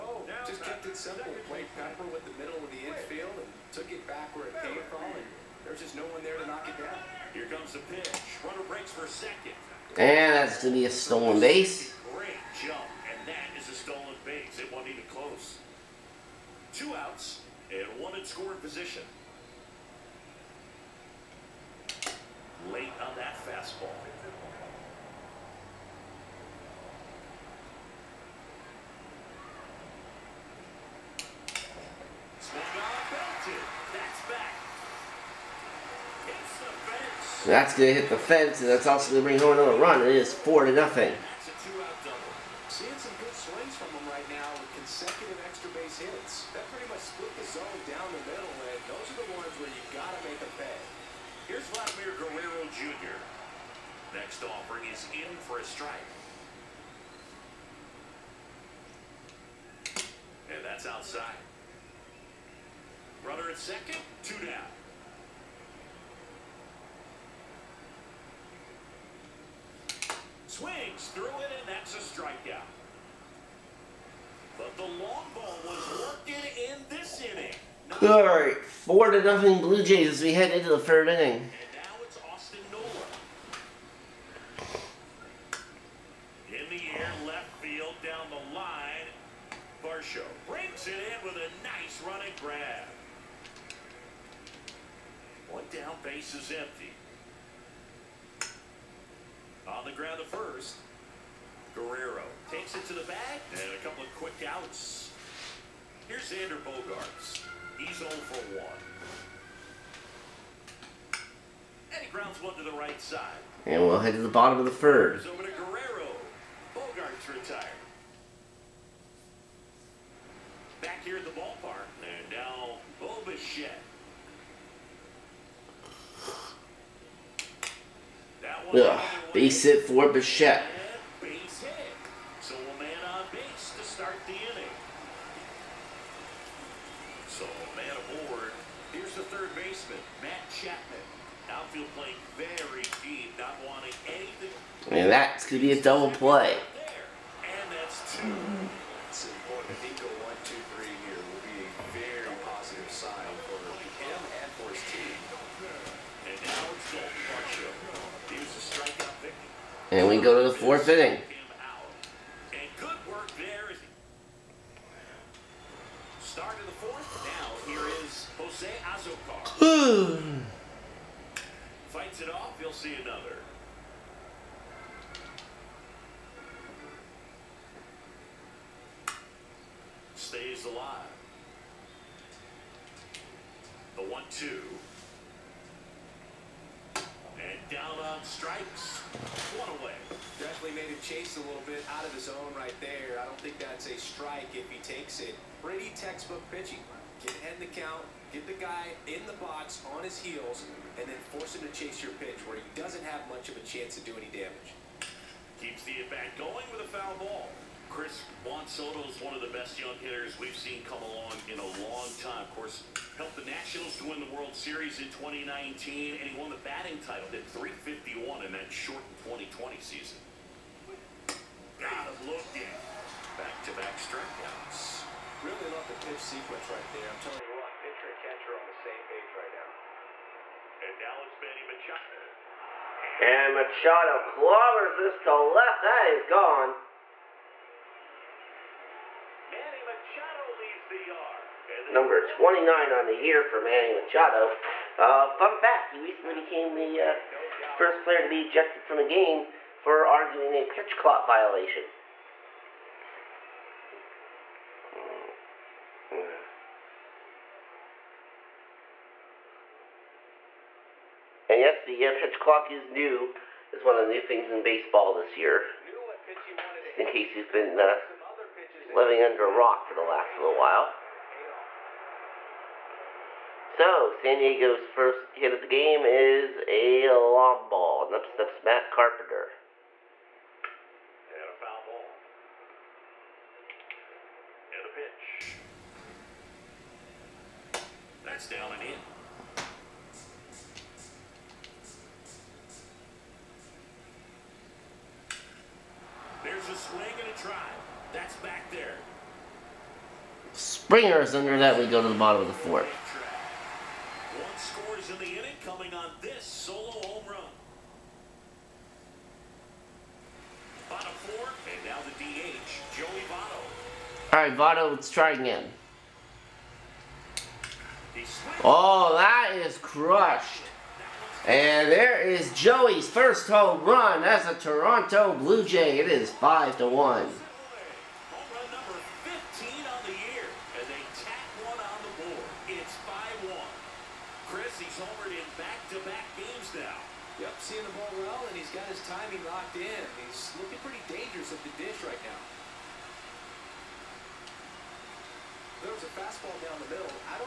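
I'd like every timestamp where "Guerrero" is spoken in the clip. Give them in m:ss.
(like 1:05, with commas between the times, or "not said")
0:52, 1:41, 1:55.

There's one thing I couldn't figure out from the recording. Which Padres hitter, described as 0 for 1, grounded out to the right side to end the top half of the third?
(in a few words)
Xander Bogaerts.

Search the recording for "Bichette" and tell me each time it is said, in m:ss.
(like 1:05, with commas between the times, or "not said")
2:03, 2:10.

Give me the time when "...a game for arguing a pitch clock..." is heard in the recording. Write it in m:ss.
4:08.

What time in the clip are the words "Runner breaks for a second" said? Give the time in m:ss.
0:08.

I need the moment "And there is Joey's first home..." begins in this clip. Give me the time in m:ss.
5:21.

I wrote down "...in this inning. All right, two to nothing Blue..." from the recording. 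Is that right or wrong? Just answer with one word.
wrong.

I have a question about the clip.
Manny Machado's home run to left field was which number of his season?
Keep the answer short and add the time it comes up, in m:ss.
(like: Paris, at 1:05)
29, at 4:02.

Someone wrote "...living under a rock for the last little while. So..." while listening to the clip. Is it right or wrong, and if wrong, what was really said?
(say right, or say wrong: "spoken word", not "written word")
right.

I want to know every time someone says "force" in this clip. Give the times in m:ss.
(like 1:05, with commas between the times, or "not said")
3:21.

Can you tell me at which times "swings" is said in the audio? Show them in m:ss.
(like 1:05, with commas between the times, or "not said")
0:43, 1:10.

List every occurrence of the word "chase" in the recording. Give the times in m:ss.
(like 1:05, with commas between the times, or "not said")
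3:11, 3:21.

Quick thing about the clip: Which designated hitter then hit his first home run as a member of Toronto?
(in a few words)
Joey Votto.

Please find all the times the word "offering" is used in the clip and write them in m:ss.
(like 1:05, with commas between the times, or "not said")
0:54.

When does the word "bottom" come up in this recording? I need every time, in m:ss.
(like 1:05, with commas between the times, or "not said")
1:54, 5:02, 5:10.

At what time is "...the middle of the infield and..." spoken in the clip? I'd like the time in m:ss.
0:02.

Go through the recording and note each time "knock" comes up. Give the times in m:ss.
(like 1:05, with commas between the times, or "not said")
0:06.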